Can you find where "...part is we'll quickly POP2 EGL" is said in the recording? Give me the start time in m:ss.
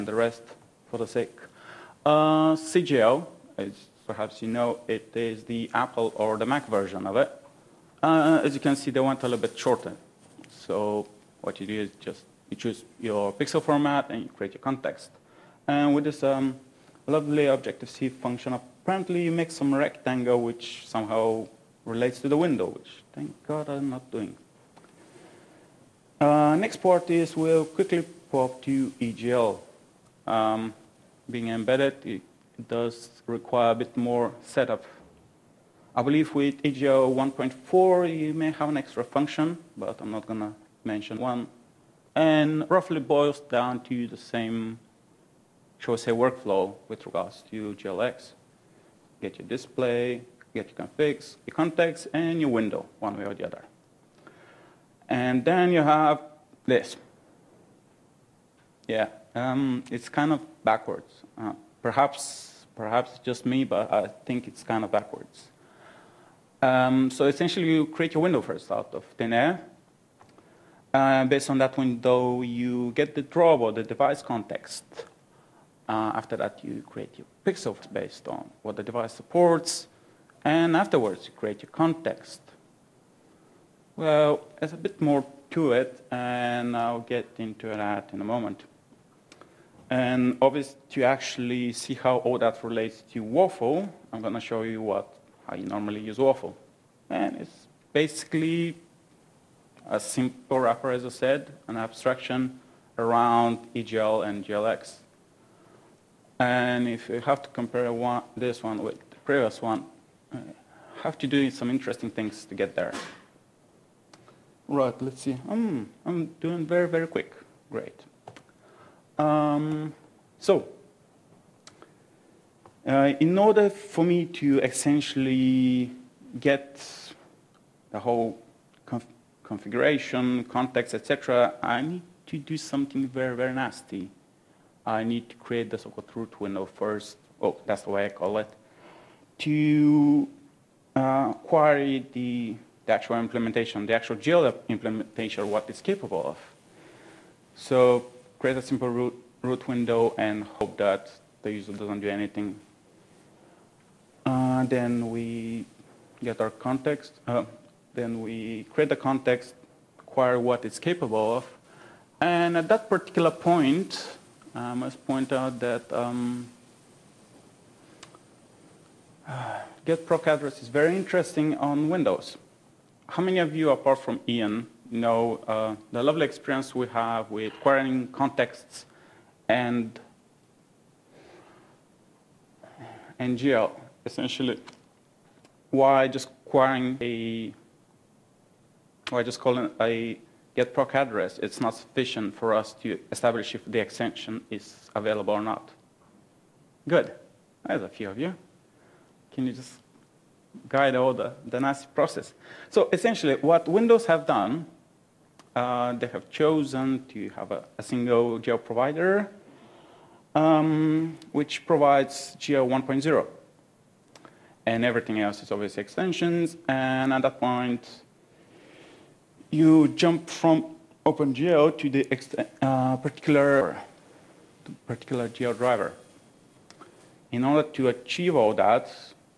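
0:26.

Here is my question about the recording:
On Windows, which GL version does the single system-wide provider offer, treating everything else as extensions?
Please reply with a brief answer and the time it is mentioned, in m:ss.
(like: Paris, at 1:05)
GL 1.0, at 3:32.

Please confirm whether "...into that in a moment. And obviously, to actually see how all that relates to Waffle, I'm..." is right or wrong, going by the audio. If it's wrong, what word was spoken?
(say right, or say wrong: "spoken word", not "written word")
right.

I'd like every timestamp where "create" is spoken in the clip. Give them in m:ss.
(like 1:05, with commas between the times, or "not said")
0:14, 1:07, 1:16, 1:21, 2:15, 2:28, 2:38.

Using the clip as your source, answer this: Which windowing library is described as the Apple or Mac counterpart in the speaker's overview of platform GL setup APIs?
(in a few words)
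CGL.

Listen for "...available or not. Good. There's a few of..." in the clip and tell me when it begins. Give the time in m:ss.
3:14.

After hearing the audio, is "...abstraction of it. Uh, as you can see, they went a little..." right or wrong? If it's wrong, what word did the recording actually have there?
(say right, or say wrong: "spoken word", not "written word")
wrong: "version", not "abstraction".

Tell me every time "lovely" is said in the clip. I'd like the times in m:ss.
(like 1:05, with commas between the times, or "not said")
0:17, 2:56.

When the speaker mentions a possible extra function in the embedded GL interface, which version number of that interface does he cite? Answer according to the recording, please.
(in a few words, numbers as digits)
EGL 1.4.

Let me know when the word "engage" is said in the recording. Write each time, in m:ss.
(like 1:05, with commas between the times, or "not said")
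not said.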